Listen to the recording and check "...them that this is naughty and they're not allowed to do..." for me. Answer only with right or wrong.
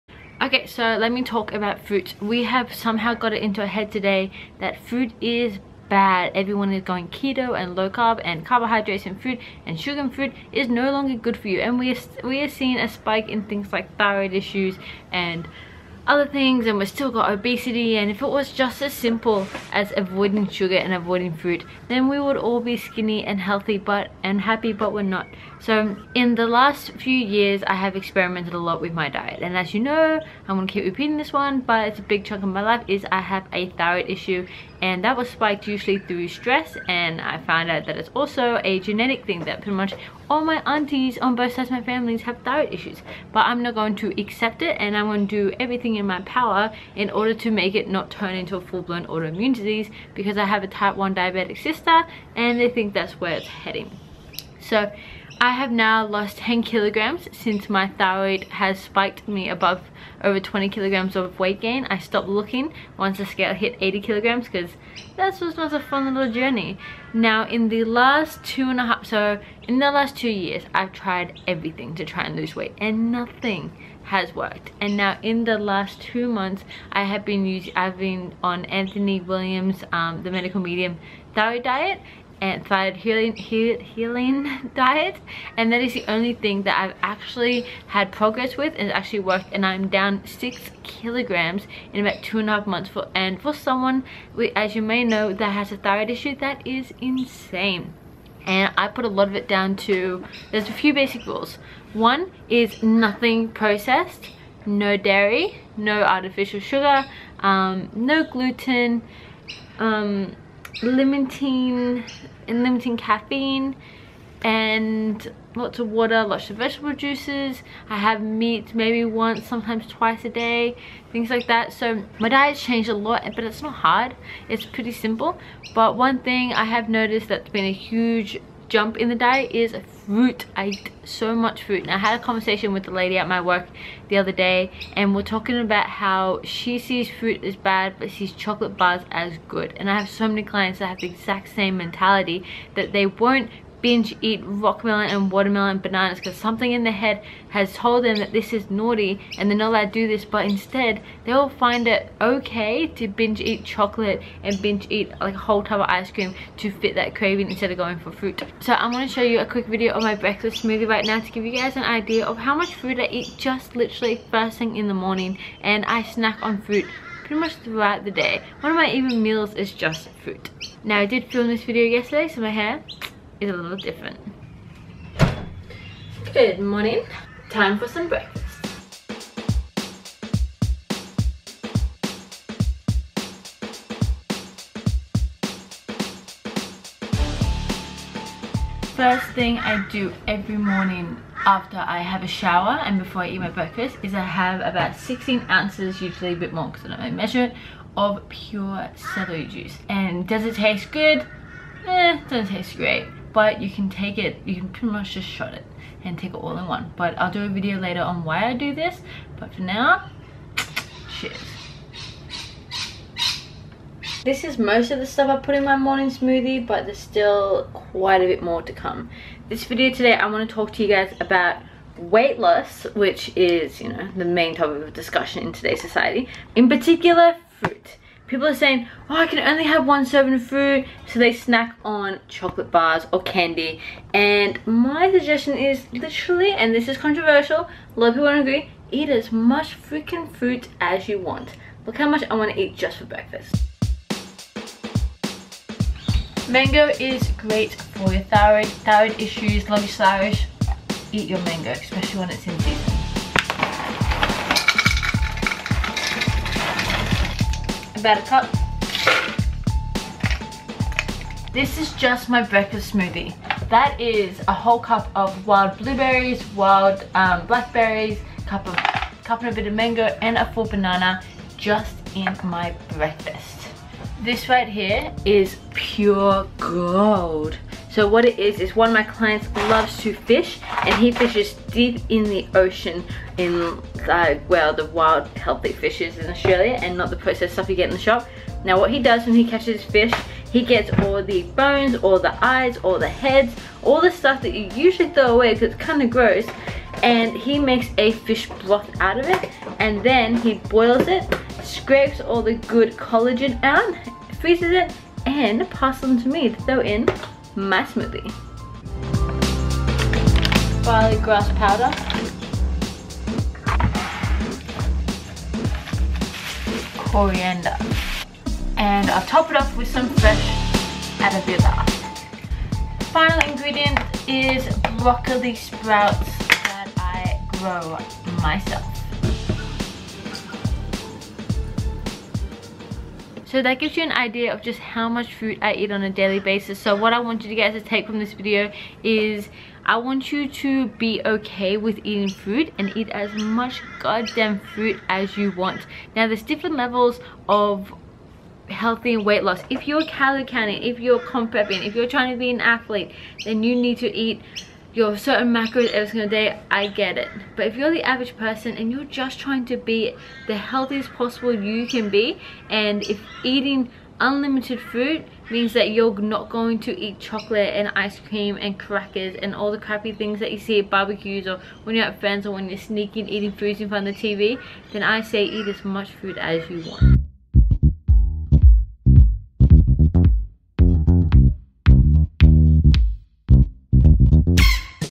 right.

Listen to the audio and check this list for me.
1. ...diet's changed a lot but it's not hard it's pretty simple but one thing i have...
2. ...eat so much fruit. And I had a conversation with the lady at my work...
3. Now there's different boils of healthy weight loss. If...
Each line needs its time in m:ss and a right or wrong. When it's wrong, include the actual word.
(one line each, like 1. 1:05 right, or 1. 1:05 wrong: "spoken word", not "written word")
1. 2:02 right
2. 2:10 right
3. 5:46 wrong: "levels", not "boils".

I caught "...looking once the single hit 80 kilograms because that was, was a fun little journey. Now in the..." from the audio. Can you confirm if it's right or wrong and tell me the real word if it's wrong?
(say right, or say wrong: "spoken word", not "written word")
wrong: "scale", not "single".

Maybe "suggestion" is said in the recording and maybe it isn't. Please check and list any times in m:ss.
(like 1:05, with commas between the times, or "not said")
3:55.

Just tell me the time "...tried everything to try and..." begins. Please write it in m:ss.
1:10.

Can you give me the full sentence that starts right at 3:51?
So they snack on chocolate bars or candy.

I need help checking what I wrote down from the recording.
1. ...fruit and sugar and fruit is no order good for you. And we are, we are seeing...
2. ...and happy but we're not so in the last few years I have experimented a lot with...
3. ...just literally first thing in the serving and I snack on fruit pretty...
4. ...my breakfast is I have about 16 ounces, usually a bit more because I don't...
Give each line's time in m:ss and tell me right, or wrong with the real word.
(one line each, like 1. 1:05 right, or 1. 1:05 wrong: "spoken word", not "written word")
1. 0:09 wrong: "longer", not "order"
2. 0:24 right
3. 2:43 wrong: "morning", not "serving"
4. 3:13 right.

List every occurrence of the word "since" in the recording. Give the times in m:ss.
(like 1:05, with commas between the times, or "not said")
0:57.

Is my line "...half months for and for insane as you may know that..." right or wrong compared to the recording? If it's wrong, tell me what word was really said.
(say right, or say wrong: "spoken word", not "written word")
wrong: "someone", not "insane".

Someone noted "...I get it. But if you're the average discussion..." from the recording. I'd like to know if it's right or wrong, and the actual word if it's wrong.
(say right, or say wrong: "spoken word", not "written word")
wrong: "person", not "discussion".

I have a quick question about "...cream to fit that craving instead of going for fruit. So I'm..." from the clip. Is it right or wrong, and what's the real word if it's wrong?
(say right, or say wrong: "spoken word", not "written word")
right.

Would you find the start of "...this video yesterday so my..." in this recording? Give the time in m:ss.
2:51.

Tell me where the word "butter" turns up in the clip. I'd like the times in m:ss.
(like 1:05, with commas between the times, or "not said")
not said.